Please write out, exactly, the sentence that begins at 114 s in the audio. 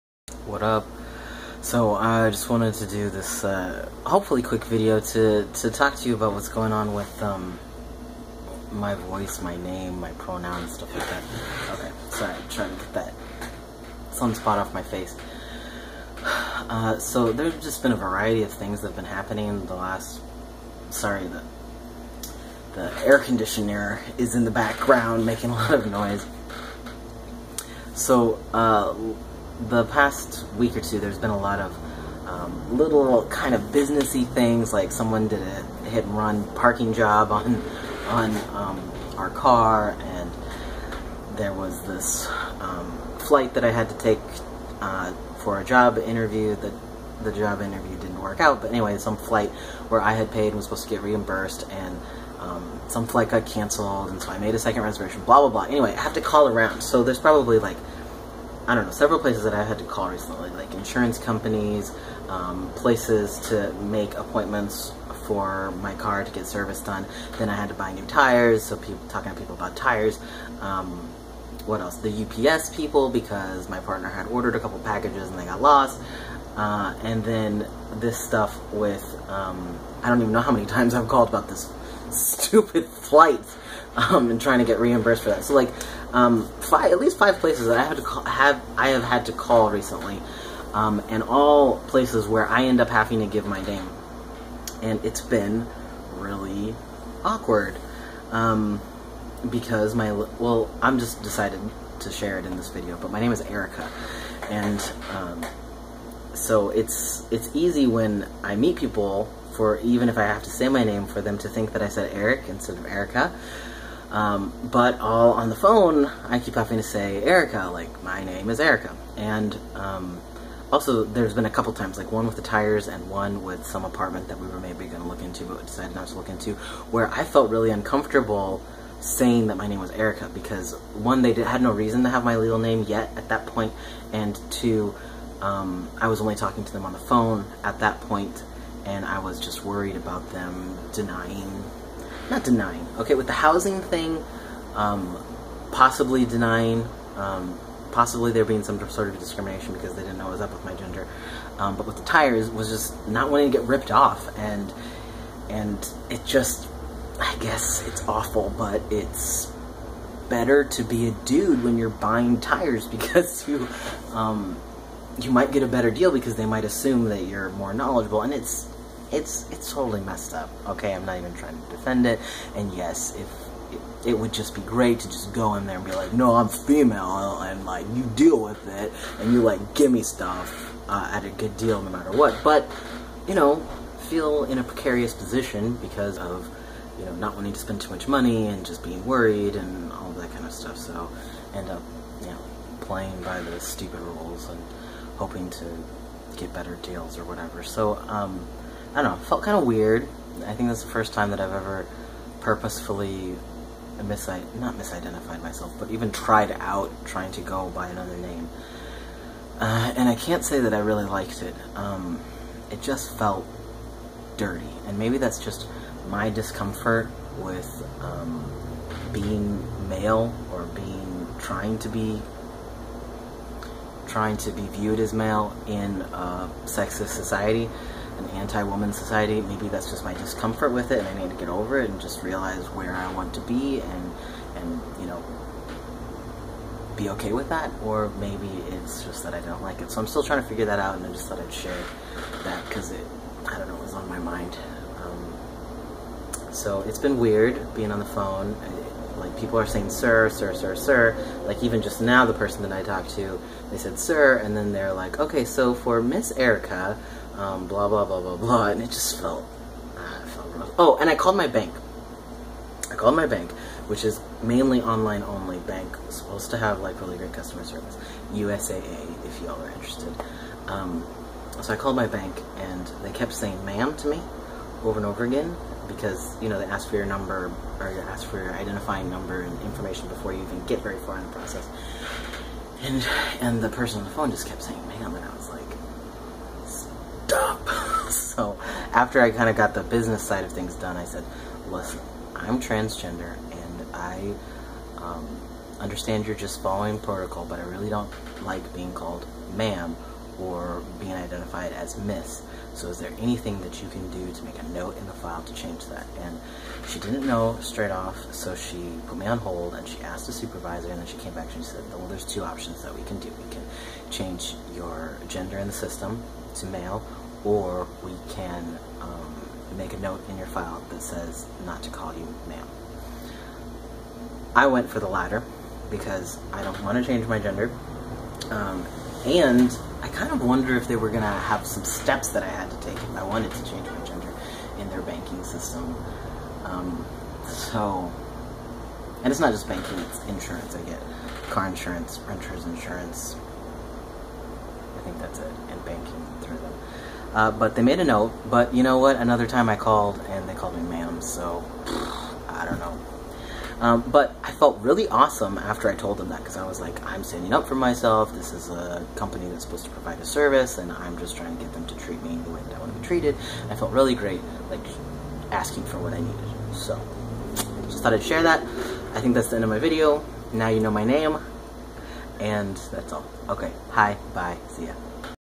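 Um, but all on the phone, I keep having to say Erica, like my name is Erica.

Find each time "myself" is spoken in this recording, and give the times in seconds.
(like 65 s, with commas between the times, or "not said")
205 s, 357 s.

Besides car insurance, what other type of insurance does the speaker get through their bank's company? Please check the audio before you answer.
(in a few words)
Renter's insurance.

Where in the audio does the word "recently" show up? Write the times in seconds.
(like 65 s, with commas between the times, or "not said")
60 s, 89 s.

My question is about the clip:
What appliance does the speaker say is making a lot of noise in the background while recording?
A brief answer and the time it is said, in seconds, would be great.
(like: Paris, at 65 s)
Air conditioner, at 23 s.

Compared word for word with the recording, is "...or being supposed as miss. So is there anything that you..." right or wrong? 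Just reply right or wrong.
wrong.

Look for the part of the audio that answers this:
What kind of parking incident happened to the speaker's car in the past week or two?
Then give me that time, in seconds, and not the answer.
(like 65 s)
35 s.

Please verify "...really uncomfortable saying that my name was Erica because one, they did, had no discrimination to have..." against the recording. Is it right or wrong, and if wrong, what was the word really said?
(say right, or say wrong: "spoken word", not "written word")
wrong: "reason", not "discrimination".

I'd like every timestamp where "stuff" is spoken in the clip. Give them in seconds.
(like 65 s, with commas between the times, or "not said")
10 s, 78 s, 180 s, 190 s.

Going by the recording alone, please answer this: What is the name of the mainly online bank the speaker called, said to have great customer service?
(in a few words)
USAA.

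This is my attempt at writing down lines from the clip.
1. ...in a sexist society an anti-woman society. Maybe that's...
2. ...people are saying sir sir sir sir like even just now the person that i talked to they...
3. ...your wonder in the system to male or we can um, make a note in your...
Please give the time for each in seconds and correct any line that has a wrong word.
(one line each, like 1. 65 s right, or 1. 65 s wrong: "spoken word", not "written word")
1. 225 s right
2. 249 s right
3. 314 s wrong: "gender", not "wonder".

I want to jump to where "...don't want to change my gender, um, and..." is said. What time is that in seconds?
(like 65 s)
326 s.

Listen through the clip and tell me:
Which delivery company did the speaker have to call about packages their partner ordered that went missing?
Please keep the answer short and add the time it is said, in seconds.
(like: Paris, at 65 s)
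UPS, at 72 s.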